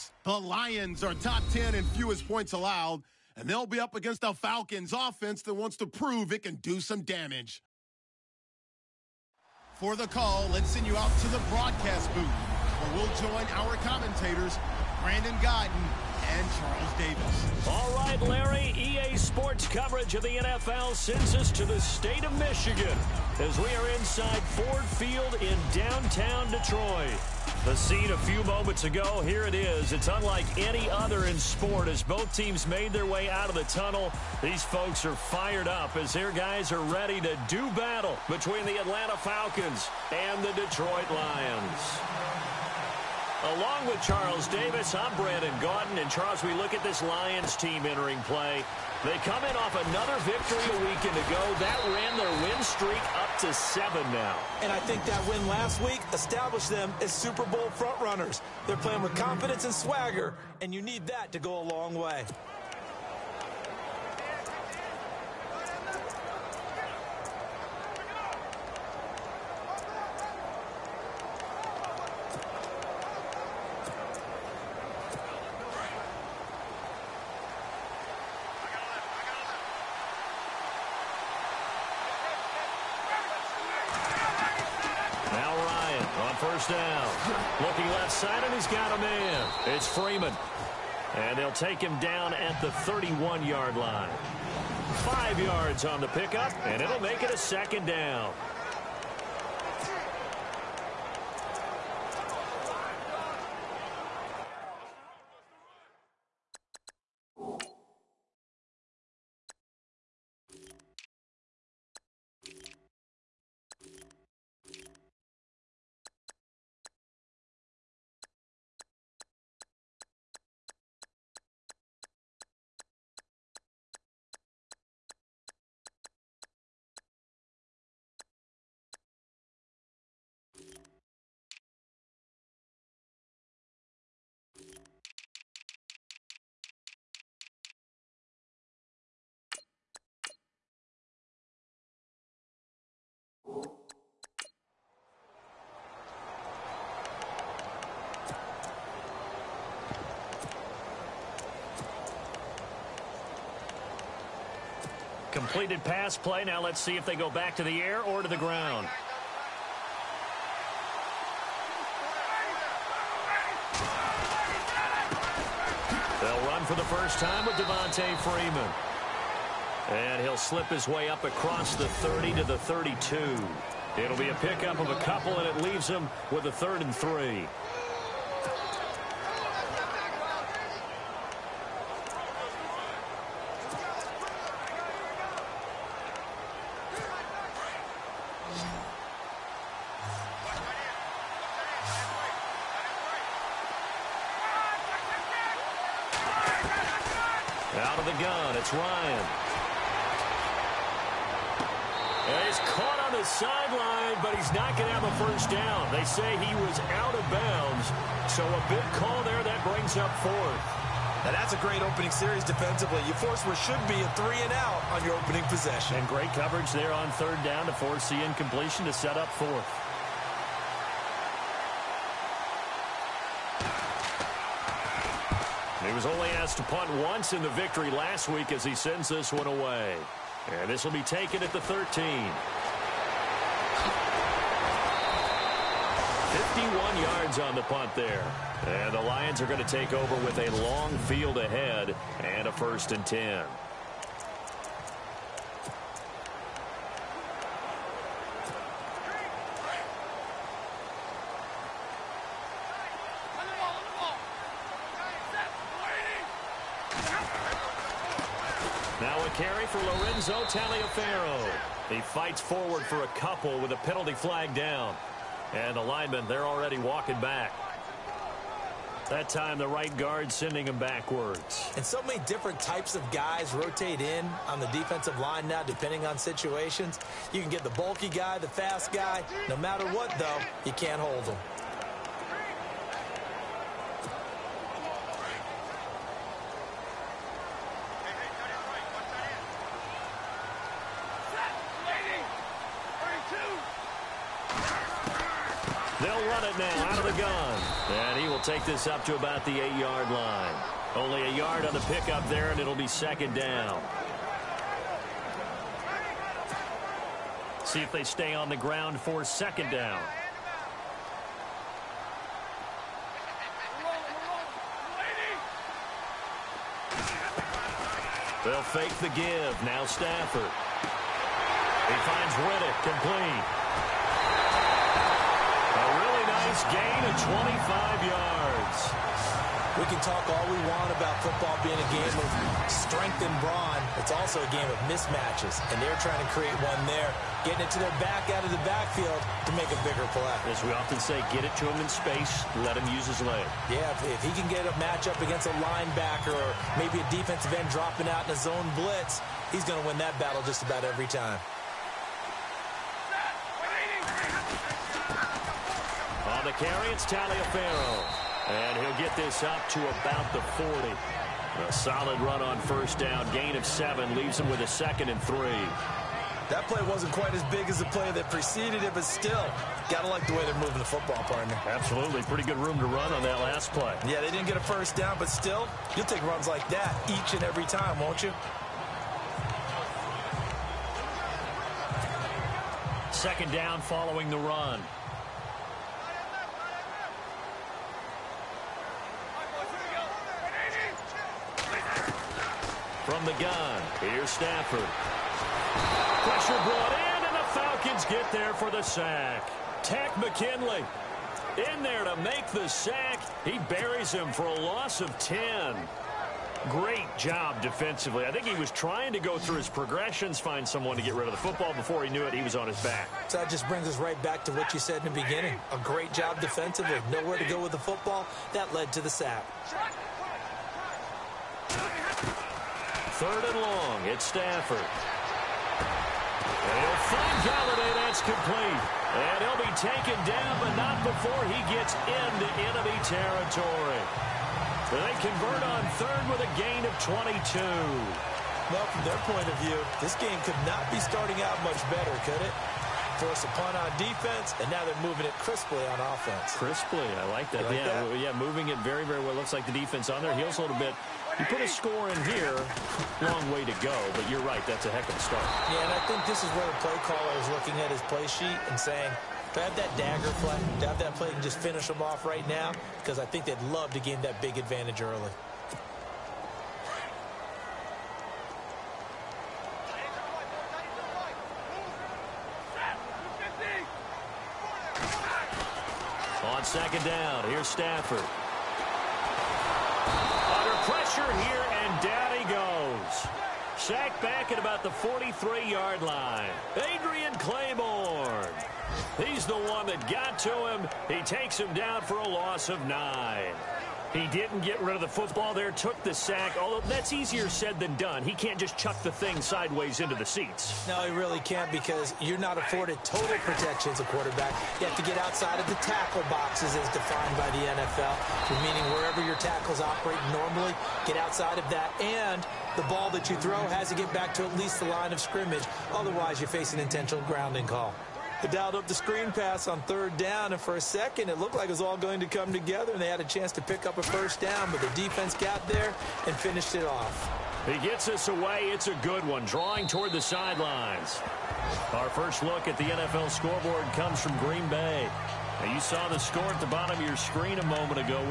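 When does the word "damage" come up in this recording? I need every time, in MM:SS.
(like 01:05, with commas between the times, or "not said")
00:07.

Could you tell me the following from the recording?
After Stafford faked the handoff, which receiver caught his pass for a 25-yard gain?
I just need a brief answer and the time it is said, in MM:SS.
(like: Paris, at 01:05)
Riddick, at 05:22.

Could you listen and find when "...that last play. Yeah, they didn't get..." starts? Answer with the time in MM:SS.
06:13.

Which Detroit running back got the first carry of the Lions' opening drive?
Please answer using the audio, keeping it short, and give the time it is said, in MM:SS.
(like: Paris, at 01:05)
Lorenzo Taliaferro, at 04:19.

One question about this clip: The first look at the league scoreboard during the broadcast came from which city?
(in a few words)
Green Bay.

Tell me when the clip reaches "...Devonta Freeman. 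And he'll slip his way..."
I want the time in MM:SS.
02:47.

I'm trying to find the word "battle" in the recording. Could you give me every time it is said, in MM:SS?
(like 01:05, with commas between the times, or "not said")
00:37, 05:50.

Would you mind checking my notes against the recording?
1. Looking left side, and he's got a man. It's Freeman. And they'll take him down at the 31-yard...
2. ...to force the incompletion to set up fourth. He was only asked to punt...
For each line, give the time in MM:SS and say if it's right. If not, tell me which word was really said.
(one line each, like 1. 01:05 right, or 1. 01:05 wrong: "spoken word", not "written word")
1. 01:27 right
2. 03:37 right.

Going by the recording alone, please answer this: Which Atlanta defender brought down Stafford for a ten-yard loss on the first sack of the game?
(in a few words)
Takk McKinley.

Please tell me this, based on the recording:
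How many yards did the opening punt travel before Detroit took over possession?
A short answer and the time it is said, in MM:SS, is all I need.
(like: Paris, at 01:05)
51, at 03:56.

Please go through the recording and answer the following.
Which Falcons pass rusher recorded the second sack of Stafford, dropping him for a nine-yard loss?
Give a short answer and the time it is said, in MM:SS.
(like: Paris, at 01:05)
Adrian Clayborn, at 08:06.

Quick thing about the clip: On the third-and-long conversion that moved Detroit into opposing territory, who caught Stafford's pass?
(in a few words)
Golladay.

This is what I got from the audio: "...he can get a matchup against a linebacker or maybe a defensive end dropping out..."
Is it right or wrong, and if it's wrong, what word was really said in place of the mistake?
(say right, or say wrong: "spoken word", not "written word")
right.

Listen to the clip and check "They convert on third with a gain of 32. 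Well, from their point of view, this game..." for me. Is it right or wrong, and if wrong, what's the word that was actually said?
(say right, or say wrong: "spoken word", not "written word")
wrong: "22", not "32".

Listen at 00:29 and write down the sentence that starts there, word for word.
It's unlike any other in sport as both teams made their way out of the tunnel.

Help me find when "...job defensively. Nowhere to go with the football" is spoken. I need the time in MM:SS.
06:56.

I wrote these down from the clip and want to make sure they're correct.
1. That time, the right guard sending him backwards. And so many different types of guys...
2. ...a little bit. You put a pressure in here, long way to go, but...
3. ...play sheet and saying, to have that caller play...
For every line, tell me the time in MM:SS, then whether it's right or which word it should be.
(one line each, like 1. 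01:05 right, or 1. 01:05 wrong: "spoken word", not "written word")
1. 04:29 right
2. 07:30 wrong: "score", not "pressure"
3. 07:38 wrong: "dagger", not "caller".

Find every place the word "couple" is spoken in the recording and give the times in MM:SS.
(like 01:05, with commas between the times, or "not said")
02:55, 04:23.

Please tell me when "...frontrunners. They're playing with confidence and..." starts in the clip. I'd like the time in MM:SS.
00:57.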